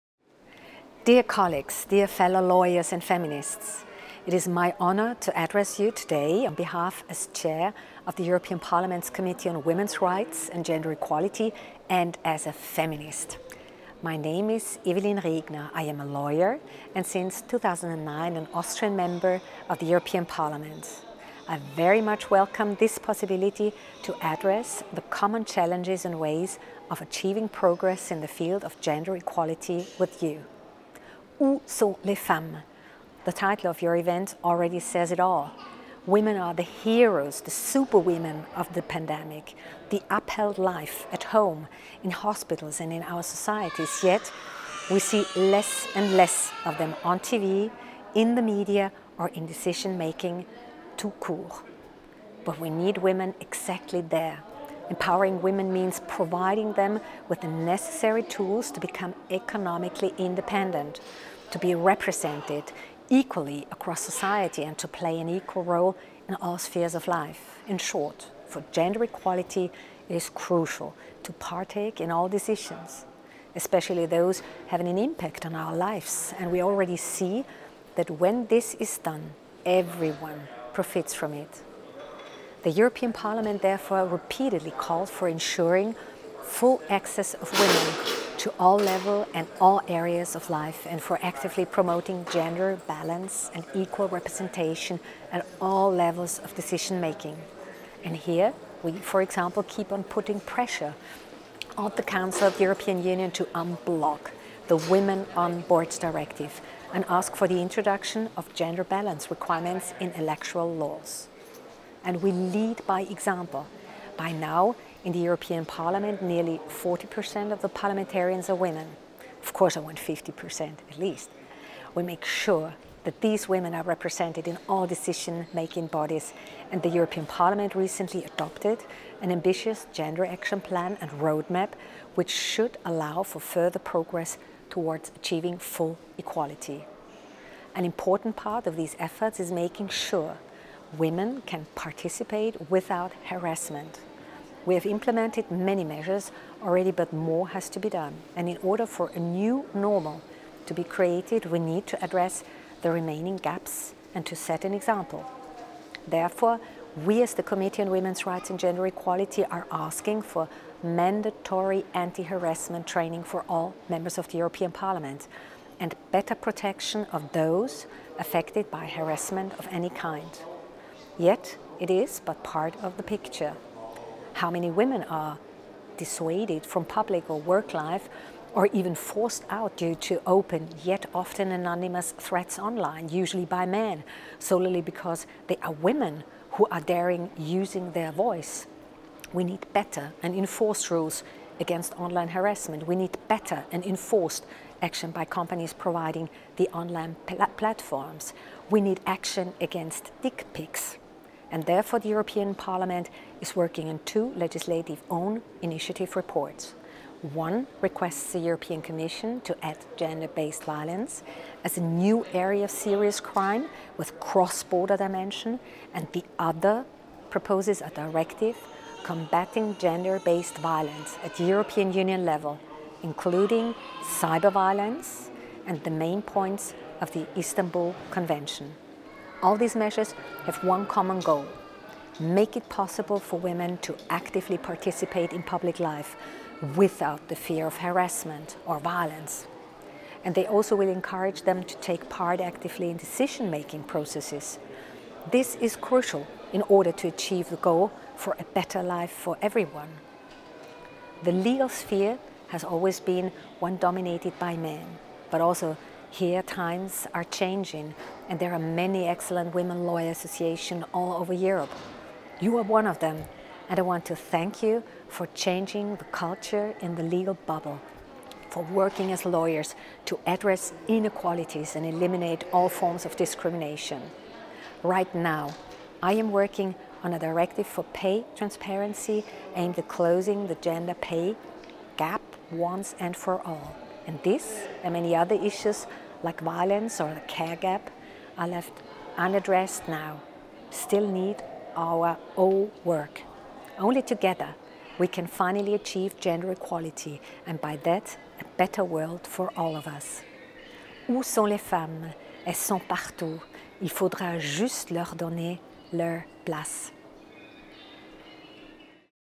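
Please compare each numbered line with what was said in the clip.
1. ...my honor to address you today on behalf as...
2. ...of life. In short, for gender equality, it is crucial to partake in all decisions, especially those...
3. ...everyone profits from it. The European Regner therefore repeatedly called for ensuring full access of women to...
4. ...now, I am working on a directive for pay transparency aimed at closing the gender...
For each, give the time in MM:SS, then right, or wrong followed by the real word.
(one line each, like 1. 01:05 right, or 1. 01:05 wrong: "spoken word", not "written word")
1. 00:04 right
2. 01:06 right
3. 01:19 wrong: "Parliament", not "Regner"
4. 04:35 right.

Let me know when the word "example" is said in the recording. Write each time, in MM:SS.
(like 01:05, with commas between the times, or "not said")
01:39, 01:53, 02:34.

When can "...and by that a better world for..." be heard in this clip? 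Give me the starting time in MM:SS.
04:57.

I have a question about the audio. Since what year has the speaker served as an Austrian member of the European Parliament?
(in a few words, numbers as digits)
2009.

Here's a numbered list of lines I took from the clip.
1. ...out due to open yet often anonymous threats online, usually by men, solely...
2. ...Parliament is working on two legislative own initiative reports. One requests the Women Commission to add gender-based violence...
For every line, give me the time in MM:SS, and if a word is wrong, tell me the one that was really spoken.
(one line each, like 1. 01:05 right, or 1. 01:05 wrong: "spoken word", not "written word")
1. 02:59 right
2. 03:22 wrong: "European", not "Women".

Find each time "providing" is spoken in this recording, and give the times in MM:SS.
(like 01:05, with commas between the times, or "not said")
00:56, 03:15.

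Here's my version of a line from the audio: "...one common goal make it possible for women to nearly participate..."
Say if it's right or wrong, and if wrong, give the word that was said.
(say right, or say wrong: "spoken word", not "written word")
wrong: "actively", not "nearly".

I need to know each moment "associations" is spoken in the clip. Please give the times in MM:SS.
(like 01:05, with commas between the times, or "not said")
04:20.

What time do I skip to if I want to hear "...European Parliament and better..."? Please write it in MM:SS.
02:44.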